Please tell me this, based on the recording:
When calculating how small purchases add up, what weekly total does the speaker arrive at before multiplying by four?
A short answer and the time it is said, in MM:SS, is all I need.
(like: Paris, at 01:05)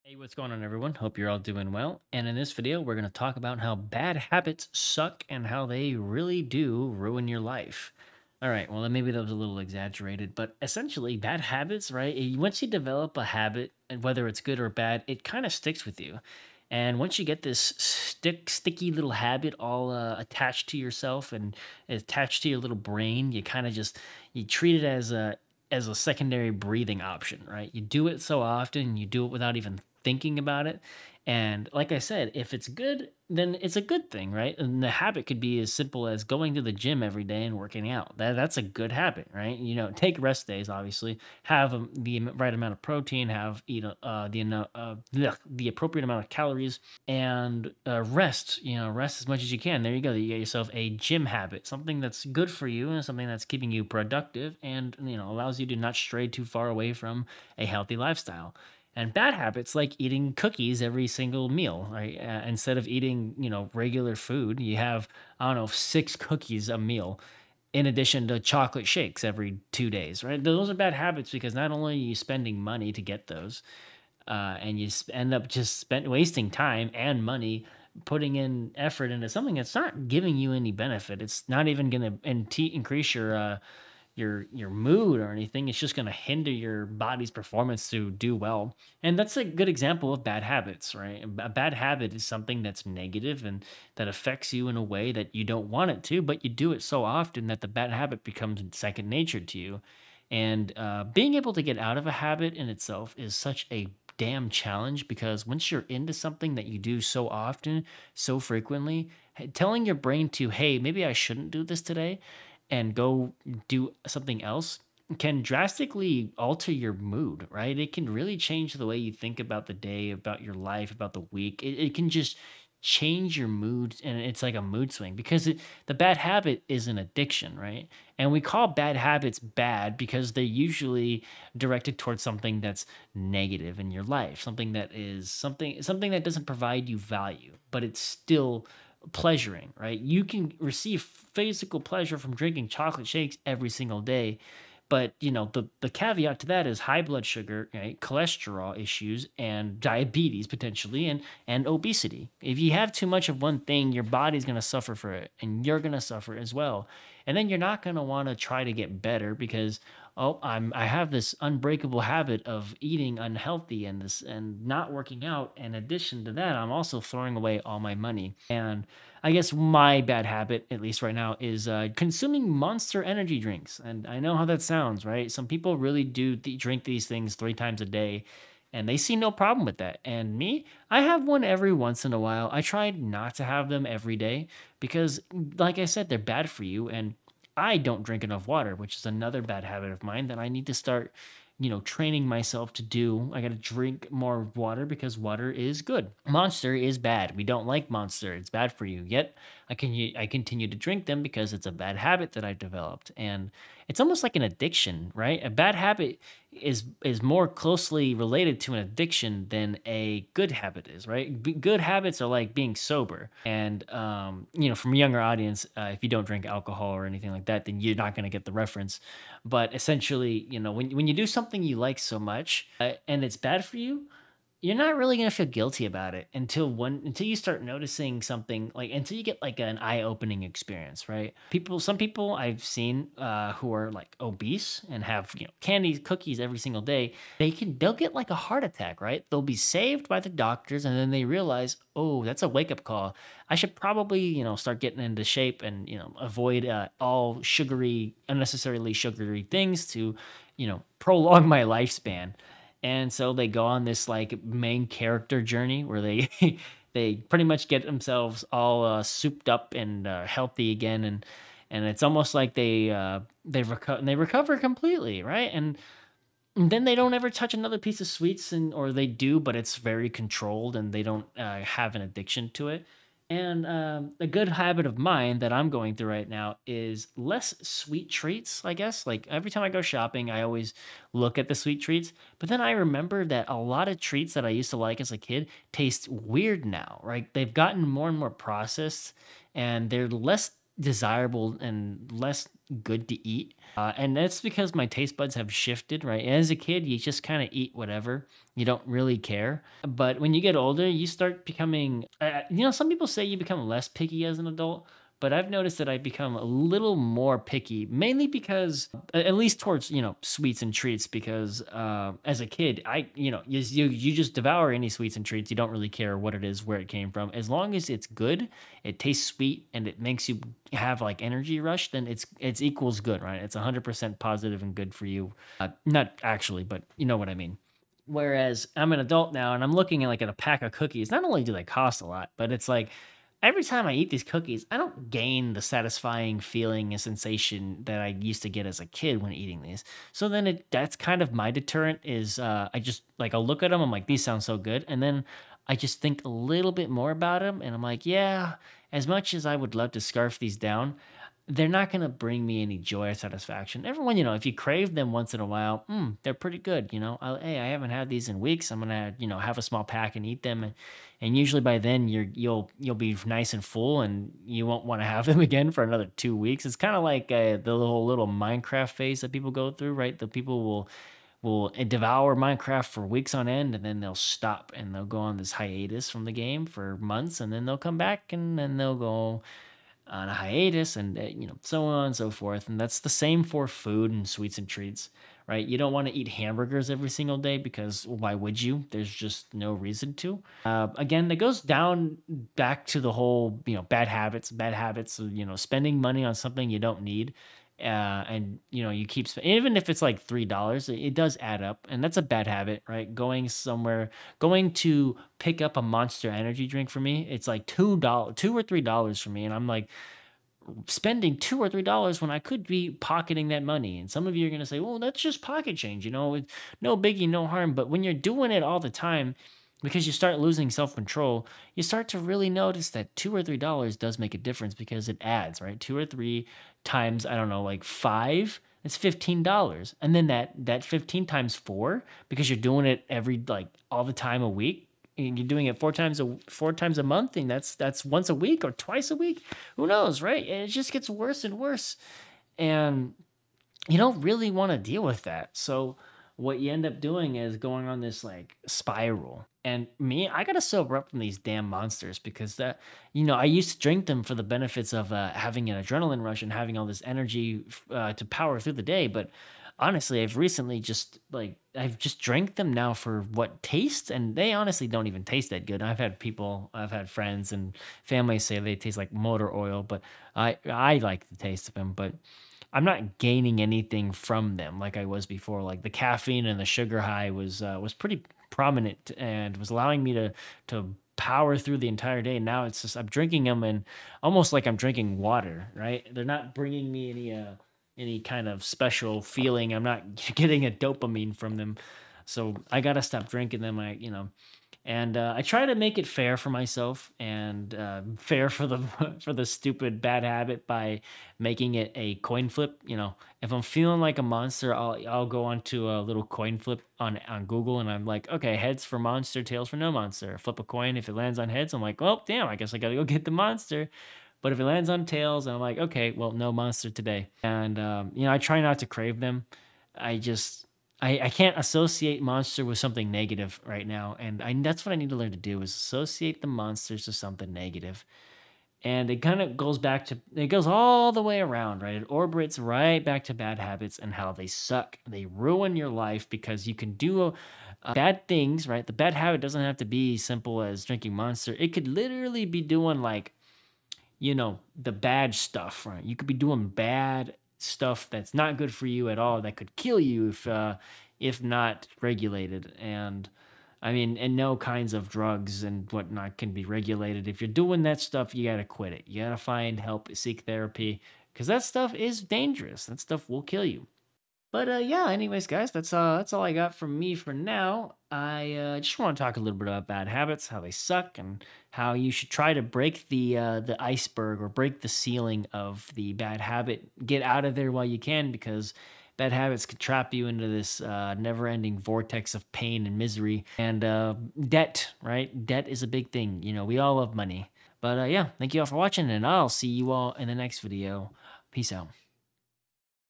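$15, at 07:08.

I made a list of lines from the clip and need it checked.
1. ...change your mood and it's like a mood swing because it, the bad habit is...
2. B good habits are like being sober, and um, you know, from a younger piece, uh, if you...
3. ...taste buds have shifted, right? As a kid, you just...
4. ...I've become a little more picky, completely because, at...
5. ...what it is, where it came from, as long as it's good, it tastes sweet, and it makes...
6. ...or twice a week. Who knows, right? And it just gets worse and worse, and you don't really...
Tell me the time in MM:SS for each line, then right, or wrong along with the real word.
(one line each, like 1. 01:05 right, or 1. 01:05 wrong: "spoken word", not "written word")
1. 02:02 right
2. 03:31 wrong: "audience", not "piece"
3. 04:54 right
4. 05:05 wrong: "mainly", not "completely"
5. 05:16 right
6. 07:18 right.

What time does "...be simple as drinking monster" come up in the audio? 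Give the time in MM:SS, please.
08:59.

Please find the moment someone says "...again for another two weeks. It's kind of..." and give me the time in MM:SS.
06:05.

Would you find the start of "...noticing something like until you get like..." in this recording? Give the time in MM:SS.
03:47.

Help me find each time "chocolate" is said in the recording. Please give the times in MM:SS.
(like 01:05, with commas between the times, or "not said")
01:08, 02:22.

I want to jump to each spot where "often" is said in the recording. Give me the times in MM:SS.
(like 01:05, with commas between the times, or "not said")
00:28, 01:37, 01:47.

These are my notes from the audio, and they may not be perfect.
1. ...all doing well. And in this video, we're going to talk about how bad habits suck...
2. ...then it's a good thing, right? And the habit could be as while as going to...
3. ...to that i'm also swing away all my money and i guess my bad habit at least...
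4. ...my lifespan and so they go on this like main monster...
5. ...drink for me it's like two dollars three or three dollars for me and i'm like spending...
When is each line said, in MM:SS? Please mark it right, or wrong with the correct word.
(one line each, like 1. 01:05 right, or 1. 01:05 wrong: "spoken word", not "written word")
1. 00:01 right
2. 00:33 wrong: "simple", not "while"
3. 02:46 wrong: "throwing", not "swing"
4. 04:11 wrong: "character", not "monster"
5. 06:46 wrong: "two", not "three".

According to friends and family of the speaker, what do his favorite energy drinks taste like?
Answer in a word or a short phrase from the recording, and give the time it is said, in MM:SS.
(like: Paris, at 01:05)
Motor oil, at 07:49.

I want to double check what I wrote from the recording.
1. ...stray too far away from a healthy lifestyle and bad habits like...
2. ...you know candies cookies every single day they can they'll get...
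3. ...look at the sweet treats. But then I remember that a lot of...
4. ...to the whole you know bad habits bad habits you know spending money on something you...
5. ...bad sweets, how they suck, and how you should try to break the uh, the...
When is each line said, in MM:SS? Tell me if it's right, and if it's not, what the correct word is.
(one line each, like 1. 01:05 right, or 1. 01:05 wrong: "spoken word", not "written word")
1. 00:55 right
2. 03:55 right
3. 04:41 right
4. 06:32 right
5. 09:29 wrong: "habits", not "sweets".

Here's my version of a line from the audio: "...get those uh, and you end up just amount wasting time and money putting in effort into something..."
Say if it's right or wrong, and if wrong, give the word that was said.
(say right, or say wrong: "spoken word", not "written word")
wrong: "spent", not "amount".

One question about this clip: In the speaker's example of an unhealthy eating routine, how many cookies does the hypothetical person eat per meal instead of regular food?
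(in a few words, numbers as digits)
6.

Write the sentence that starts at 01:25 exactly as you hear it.
It's just going to hinder your body's performance to do well.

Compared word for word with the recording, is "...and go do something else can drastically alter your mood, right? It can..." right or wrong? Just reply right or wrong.
right.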